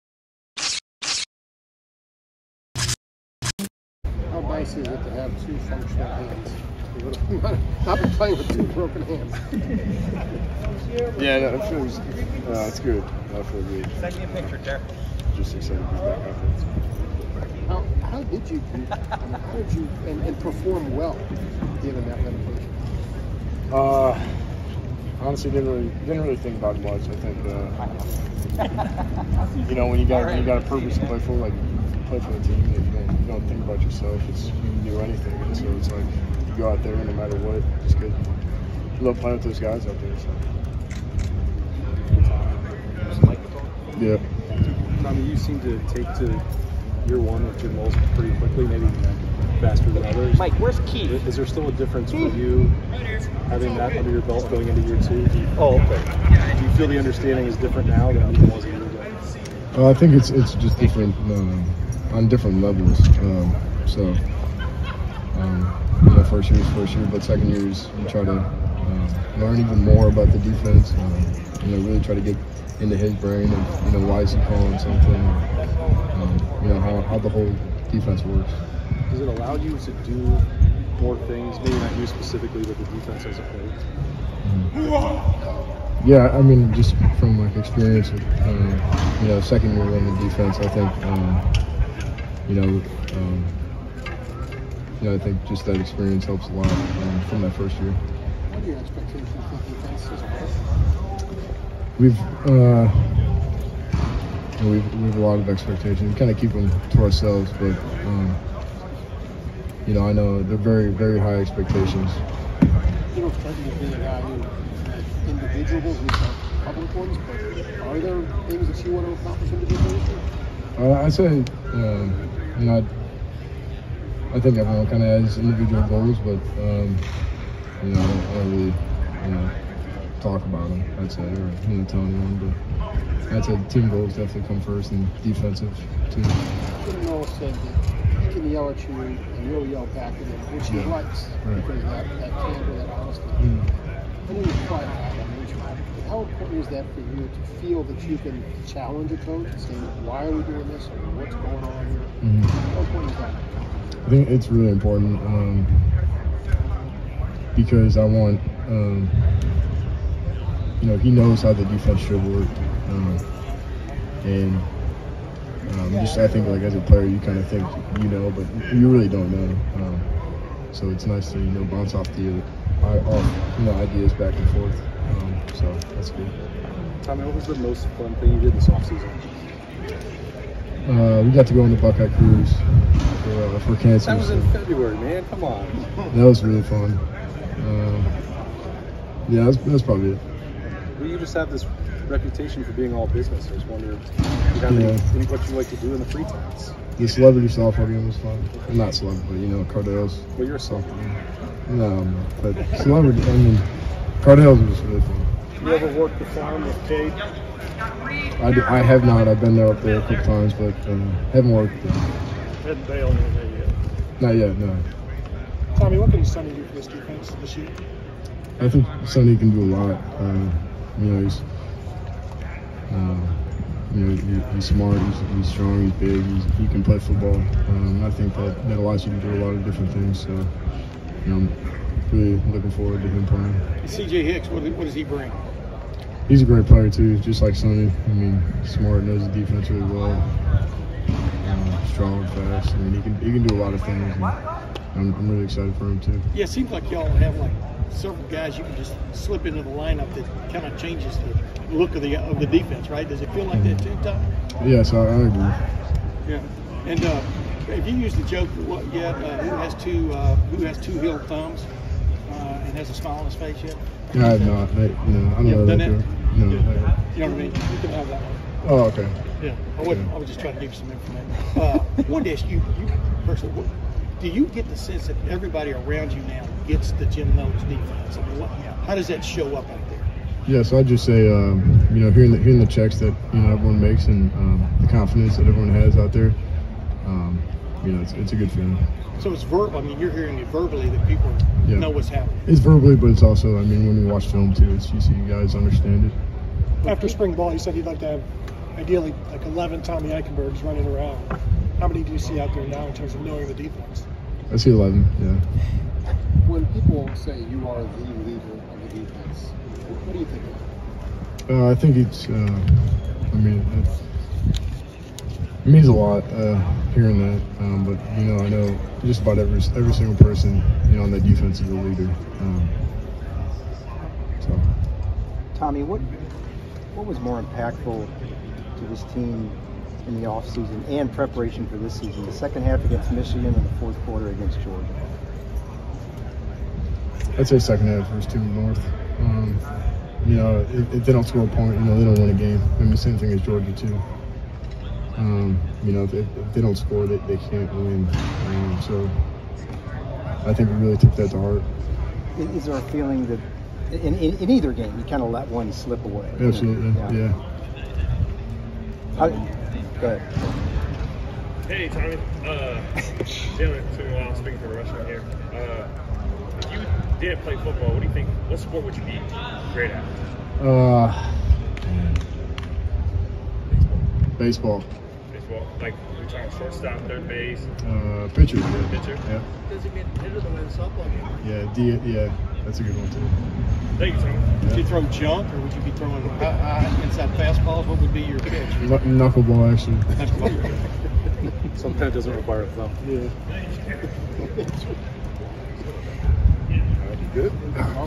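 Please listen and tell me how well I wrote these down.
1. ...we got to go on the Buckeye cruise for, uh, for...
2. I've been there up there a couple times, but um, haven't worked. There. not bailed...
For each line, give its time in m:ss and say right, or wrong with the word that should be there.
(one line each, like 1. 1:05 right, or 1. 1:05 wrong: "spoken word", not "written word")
1. 3:01 right
2. 3:29 right.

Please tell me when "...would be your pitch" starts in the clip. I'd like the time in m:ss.
6:27.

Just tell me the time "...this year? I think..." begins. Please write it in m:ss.
3:37.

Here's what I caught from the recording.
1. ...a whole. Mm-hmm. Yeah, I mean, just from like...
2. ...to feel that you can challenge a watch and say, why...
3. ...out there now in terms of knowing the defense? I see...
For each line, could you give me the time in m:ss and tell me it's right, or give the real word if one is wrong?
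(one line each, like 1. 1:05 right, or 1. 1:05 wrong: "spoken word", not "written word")
1. 1:23 right
2. 2:27 wrong: "coach", not "watch"
3. 5:02 right.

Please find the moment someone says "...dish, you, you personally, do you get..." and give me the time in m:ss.
4:32.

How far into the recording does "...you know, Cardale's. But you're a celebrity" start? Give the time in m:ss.
3:19.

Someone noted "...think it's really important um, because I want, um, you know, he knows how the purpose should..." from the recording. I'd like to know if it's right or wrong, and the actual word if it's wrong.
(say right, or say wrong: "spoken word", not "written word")
wrong: "defense", not "purpose".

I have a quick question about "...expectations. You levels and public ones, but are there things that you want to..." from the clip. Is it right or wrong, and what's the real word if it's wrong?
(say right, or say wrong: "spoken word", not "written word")
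wrong: "individuals", not "levels".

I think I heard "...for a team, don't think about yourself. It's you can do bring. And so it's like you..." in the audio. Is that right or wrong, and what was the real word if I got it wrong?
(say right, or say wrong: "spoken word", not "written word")
wrong: "anything", not "bring".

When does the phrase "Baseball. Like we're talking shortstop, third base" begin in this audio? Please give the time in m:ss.
6:15.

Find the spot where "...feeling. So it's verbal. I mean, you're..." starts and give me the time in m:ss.
4:48.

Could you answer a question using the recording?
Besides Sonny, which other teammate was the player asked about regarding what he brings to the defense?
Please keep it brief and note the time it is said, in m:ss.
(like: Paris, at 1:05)
CJ Hicks, at 3:53.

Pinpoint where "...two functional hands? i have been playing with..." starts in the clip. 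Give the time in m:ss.
0:05.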